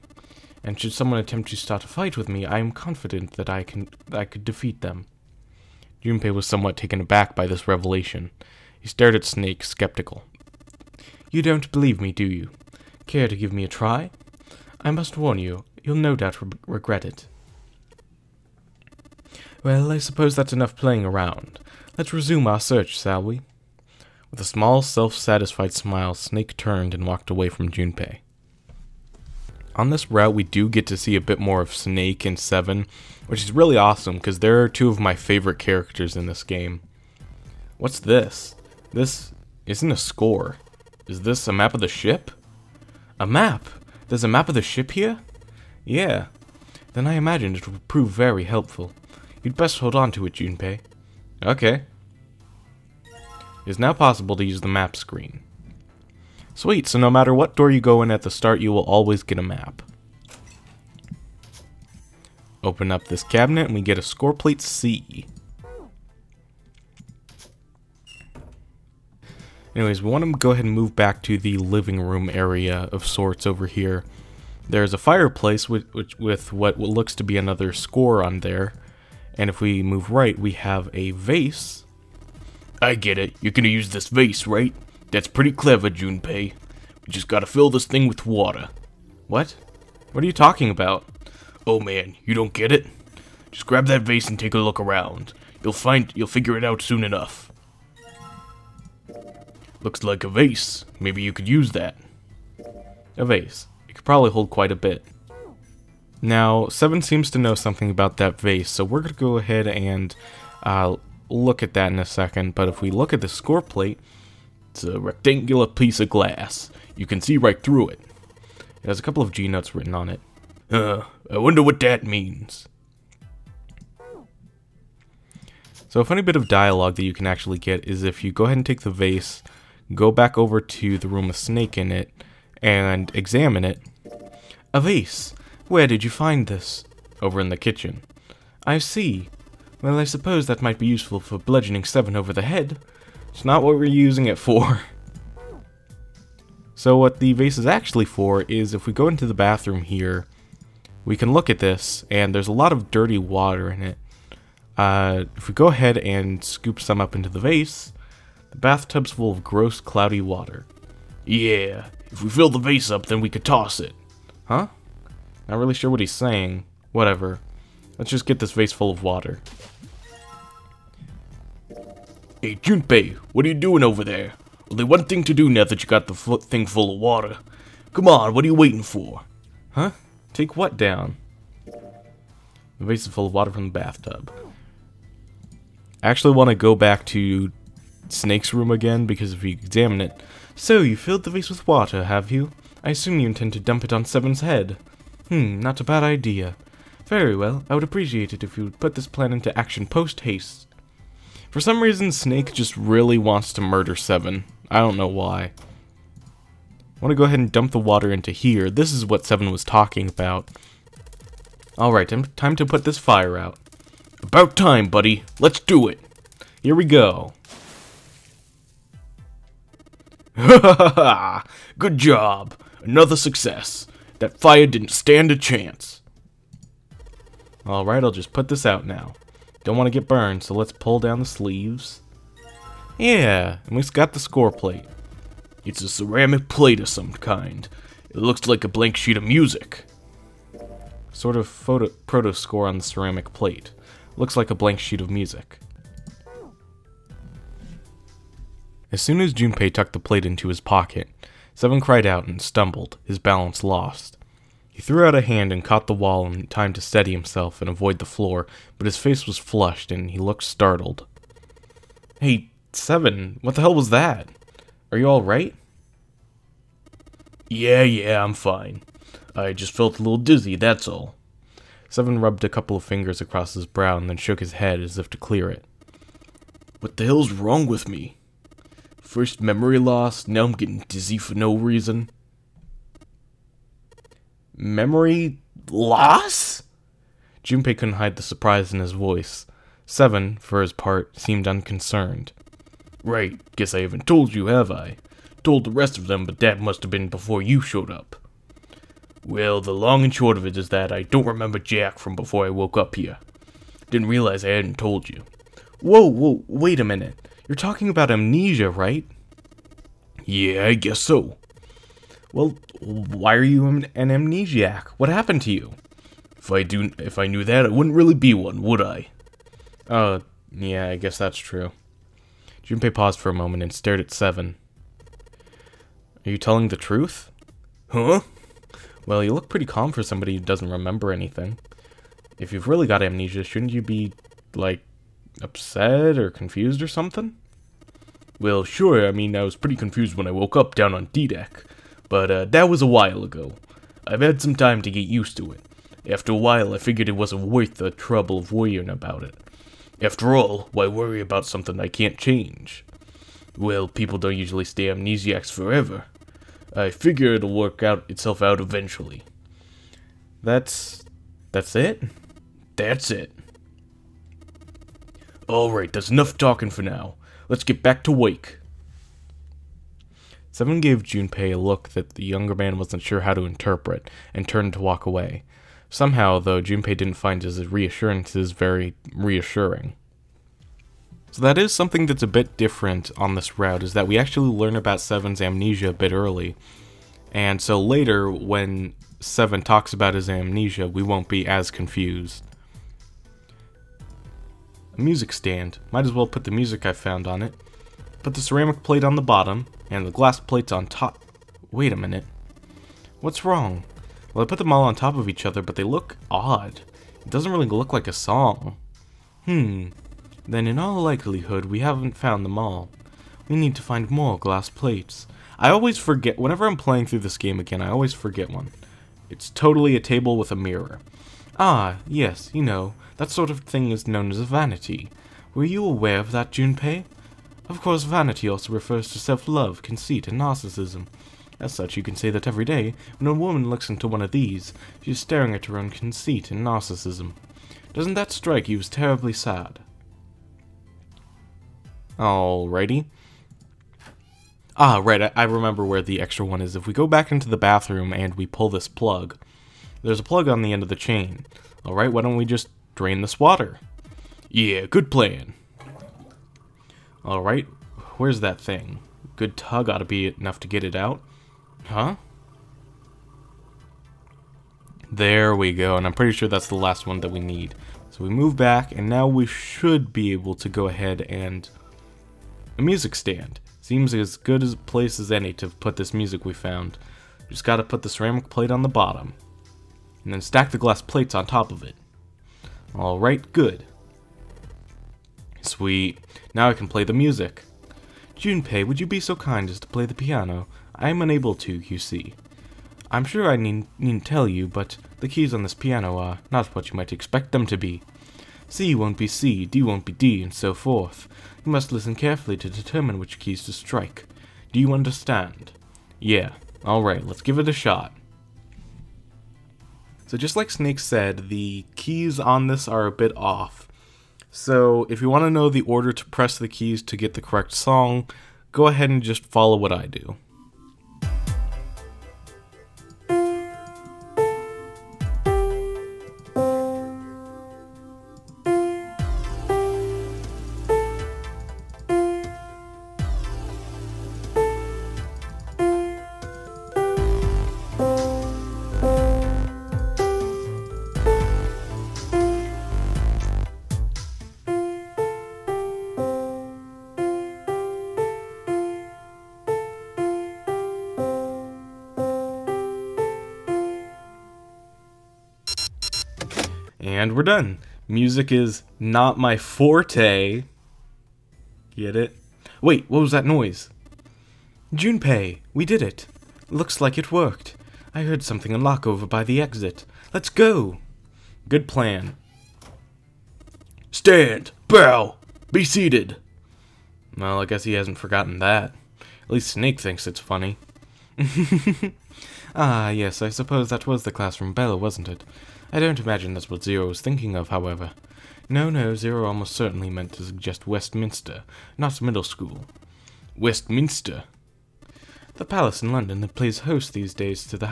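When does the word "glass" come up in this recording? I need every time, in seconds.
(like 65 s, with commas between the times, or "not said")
116 s, 400 s, 414 s, 480 s.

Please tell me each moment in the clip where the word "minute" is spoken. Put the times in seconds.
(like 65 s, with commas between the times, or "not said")
306 s, 401 s.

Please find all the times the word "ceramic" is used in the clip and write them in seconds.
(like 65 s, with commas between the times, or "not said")
235 s, 242 s, 398 s, 478 s.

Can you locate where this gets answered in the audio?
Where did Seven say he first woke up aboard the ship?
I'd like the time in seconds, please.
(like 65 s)
341 s.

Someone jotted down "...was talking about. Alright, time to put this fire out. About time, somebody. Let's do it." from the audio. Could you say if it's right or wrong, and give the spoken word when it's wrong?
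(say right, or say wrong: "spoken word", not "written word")
wrong: "buddy", not "somebody".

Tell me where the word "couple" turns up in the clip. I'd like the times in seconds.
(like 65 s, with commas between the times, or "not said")
119 s, 272 s.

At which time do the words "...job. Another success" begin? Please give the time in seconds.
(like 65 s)
221 s.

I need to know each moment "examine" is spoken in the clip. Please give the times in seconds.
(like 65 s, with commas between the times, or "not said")
133 s, 189 s.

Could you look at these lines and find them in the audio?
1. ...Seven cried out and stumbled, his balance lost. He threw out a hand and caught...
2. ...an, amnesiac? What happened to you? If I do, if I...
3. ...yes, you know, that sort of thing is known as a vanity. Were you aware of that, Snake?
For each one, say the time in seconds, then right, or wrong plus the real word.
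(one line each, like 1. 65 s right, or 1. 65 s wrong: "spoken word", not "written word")
1. 251 s right
2. 313 s right
3. 422 s wrong: "Junpei", not "Snake".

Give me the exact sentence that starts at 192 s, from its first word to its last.
I assume you intend to dump it on Seven's head.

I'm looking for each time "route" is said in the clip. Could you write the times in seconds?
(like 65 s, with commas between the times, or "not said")
30 s, 383 s.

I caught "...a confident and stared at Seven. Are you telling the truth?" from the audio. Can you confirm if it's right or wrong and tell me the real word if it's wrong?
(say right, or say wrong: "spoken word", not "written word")
wrong: "moment", not "confident".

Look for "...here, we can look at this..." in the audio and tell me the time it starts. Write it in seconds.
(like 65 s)
149 s.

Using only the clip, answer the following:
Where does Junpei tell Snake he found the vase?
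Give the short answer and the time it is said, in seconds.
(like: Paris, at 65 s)
The kitchen, at 137 s.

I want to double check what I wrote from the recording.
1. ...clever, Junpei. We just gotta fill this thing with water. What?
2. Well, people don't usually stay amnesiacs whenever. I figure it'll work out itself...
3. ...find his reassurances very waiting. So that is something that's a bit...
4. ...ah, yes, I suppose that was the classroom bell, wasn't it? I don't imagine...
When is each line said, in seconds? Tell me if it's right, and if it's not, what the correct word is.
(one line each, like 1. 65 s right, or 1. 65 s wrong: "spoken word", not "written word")
1. 85 s right
2. 353 s wrong: "forever", not "whenever"
3. 377 s wrong: "reassuring", not "waiting"
4. 582 s right.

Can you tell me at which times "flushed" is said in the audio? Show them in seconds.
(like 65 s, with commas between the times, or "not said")
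259 s.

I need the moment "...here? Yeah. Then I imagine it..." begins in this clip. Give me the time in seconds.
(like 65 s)
44 s.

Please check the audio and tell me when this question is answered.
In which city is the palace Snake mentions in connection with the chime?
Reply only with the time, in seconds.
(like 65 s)
596 s.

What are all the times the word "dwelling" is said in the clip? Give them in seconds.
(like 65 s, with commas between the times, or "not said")
not said.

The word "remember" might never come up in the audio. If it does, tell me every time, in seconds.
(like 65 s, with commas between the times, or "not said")
301 s, 330 s, 445 s.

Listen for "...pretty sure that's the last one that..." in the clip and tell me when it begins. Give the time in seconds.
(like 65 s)
466 s.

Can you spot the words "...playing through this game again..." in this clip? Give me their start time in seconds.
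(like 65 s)
416 s.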